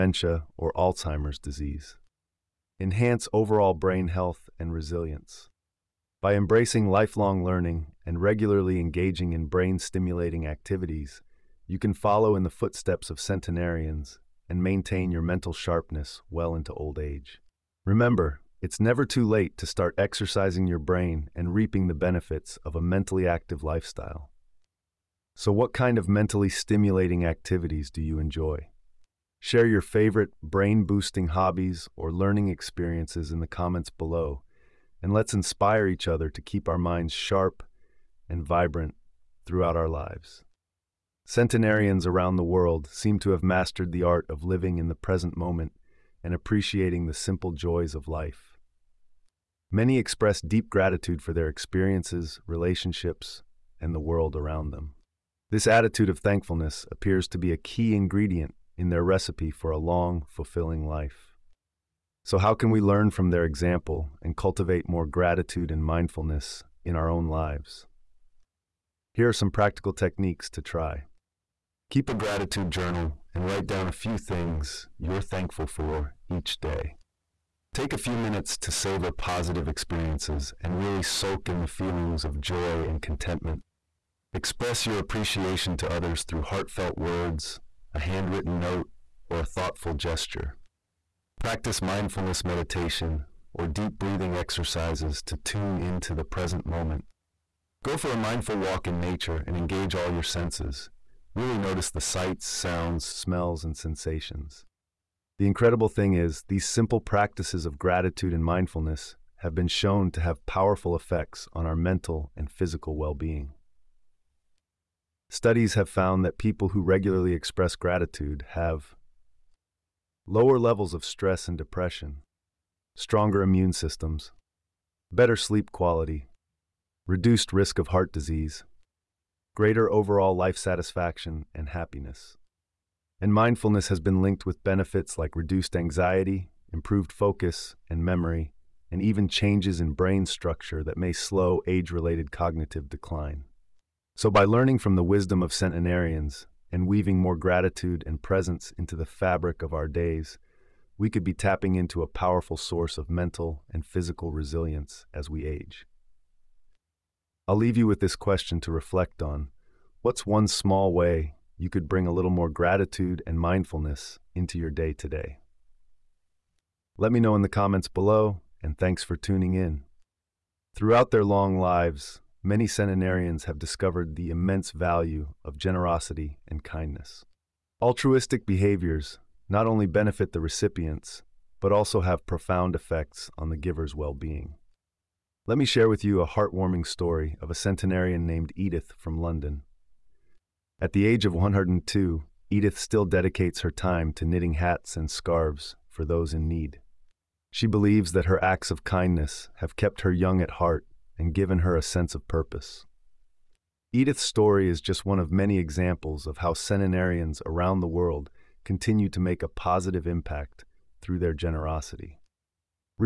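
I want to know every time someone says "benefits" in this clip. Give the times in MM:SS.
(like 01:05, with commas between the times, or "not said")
00:21, 02:14, 02:59.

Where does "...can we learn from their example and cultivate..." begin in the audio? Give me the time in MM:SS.
01:02.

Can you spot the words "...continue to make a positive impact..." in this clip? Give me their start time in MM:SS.
03:28.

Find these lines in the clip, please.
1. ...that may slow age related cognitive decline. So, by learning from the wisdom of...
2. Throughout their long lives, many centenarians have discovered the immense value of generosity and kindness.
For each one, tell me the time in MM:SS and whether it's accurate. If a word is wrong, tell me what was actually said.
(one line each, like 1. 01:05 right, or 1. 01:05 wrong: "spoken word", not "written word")
1. 02:20 right
2. 02:50 right.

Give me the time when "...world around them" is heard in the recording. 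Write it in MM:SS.
00:53.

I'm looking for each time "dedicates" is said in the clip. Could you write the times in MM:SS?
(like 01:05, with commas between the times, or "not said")
03:13.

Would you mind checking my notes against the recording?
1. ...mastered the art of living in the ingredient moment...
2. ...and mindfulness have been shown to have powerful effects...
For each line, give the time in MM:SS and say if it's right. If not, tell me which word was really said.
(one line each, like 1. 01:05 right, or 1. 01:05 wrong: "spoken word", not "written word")
1. 00:43 wrong: "present", not "ingredient"
2. 01:48 right.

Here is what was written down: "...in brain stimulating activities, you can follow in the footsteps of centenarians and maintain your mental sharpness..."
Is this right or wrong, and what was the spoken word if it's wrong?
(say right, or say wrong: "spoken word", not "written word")
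right.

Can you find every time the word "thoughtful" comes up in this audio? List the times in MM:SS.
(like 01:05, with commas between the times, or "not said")
01:29.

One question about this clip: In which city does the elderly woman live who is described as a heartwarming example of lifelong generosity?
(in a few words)
London.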